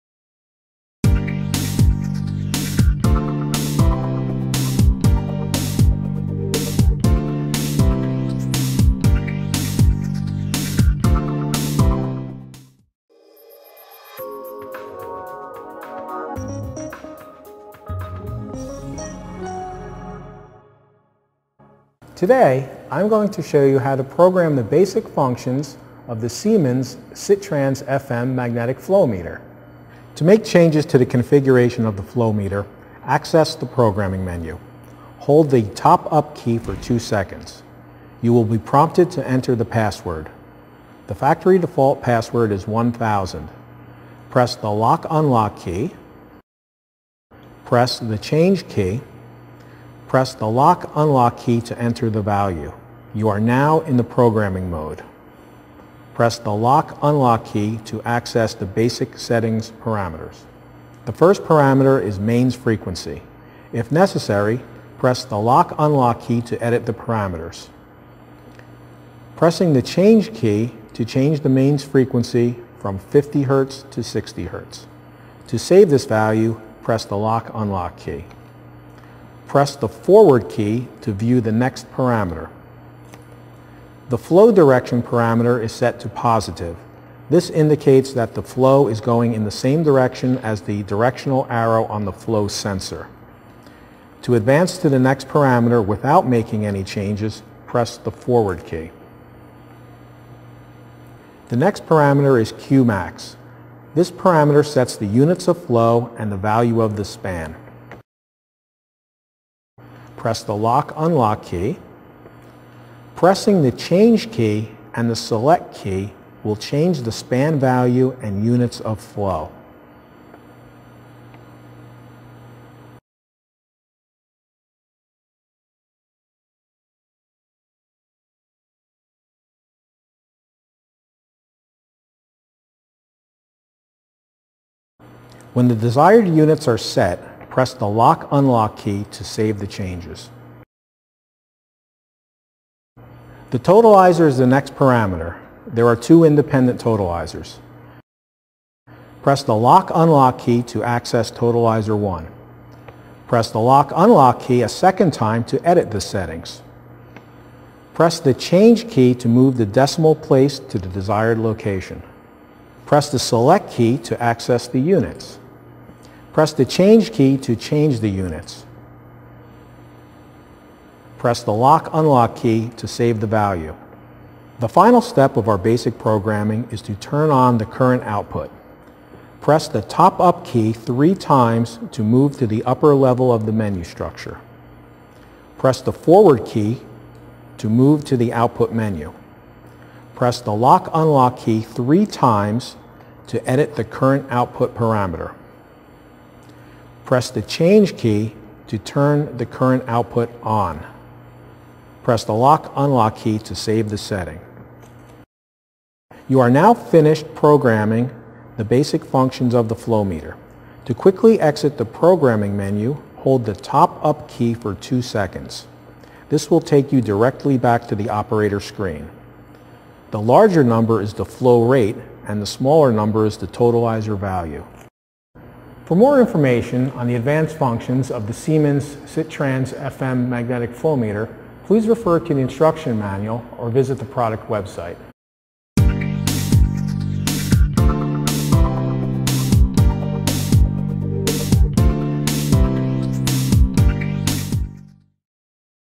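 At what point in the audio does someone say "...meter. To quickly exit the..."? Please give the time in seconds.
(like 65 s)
210 s.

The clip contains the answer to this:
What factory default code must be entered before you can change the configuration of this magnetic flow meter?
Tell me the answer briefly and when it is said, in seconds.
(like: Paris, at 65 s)
1000, at 42 s.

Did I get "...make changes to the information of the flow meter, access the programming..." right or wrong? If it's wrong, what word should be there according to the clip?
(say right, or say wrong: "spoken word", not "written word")
wrong: "configuration", not "information".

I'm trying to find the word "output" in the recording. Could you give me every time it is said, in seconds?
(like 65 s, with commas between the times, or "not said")
178 s, 188 s, 194 s, 199 s.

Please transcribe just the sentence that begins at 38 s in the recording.
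You will be prompted to enter the password.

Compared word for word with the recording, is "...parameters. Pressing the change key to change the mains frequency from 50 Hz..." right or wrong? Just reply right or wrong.
right.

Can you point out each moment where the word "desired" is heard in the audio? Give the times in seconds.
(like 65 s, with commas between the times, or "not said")
135 s, 160 s.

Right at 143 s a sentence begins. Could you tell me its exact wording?
The totalizer is the next parameter.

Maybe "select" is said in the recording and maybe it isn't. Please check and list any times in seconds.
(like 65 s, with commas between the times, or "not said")
115 s, 163 s.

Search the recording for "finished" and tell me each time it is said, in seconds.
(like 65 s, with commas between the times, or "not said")
206 s.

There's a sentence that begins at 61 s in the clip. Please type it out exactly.
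The first parameter is mains frequency.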